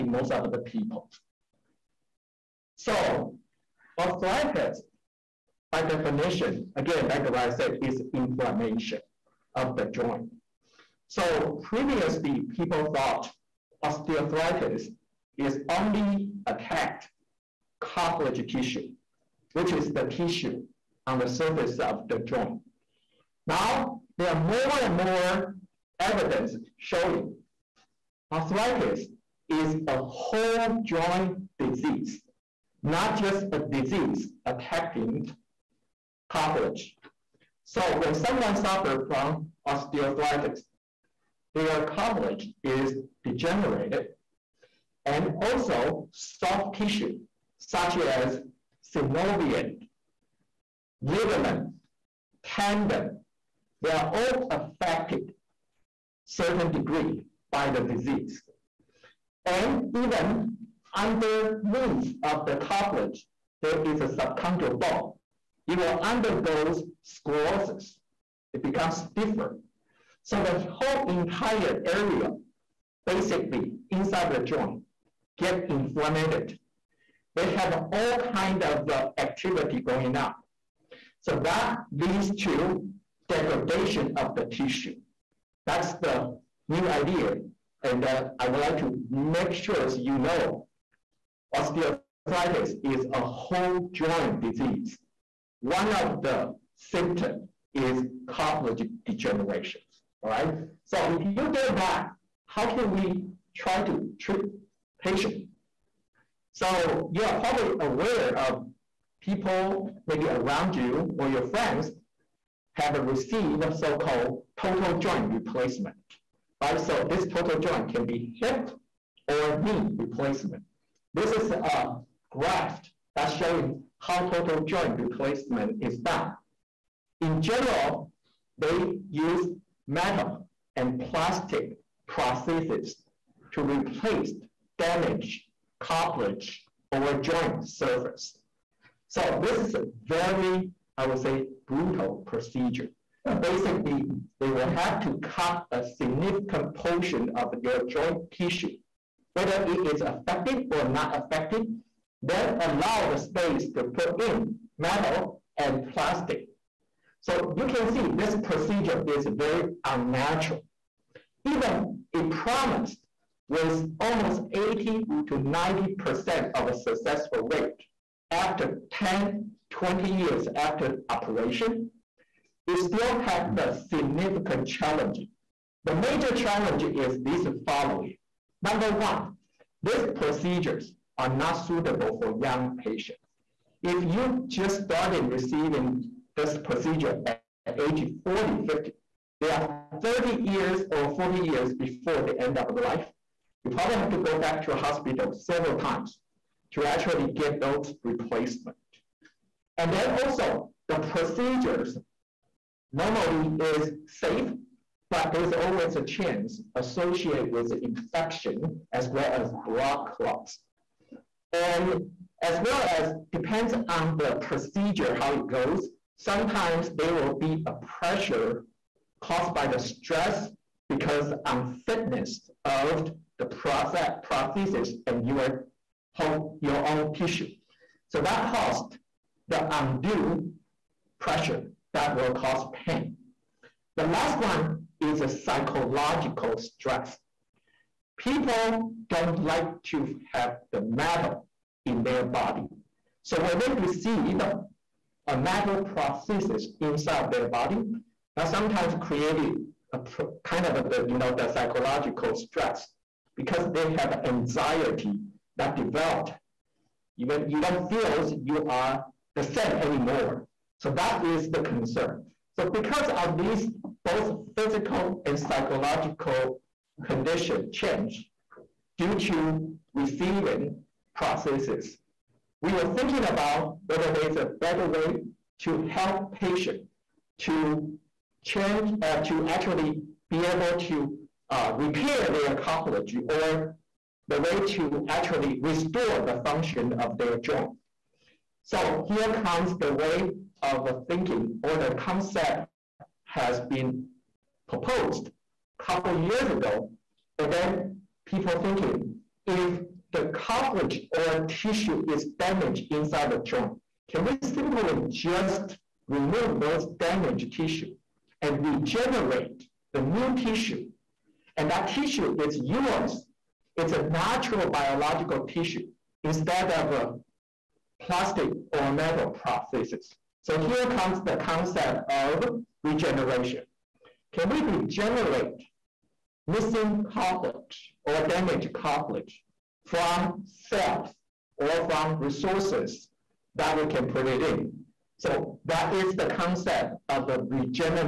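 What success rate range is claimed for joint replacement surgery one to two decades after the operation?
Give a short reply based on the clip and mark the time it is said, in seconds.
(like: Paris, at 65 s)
80 to 90%, at 164 s.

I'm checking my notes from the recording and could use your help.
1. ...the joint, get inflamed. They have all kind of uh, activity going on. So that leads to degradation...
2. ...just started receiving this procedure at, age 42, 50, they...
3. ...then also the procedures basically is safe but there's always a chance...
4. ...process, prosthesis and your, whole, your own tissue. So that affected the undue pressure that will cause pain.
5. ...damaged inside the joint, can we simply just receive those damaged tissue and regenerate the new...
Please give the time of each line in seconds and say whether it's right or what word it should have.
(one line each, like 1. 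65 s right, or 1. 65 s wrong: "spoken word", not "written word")
1. 74 s right
2. 184 s wrong: "40", not "42"
3. 199 s wrong: "normally", not "basically"
4. 223 s wrong: "caused", not "affected"
5. 302 s wrong: "remove", not "receive".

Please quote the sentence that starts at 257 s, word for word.
Even you don't feel you are the same anymore.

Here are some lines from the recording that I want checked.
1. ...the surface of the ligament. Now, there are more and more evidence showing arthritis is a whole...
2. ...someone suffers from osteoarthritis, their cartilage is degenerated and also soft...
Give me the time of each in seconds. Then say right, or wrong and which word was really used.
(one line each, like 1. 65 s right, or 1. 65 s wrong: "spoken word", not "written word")
1. 21 s wrong: "joint", not "ligament"
2. 38 s right.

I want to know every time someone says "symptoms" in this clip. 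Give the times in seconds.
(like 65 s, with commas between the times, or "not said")
96 s.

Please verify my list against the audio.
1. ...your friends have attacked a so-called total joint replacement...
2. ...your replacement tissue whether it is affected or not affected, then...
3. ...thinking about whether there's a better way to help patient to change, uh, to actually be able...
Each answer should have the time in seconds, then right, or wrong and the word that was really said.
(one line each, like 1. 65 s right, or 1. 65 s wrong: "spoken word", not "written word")
1. 111 s wrong: "received", not "attacked"
2. 147 s wrong: "joint", not "replacement"
3. 272 s right.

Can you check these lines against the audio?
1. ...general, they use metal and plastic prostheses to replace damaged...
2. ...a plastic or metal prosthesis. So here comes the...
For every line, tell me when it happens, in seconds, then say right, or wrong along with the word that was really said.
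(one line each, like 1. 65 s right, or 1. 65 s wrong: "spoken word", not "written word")
1. 127 s right
2. 316 s right.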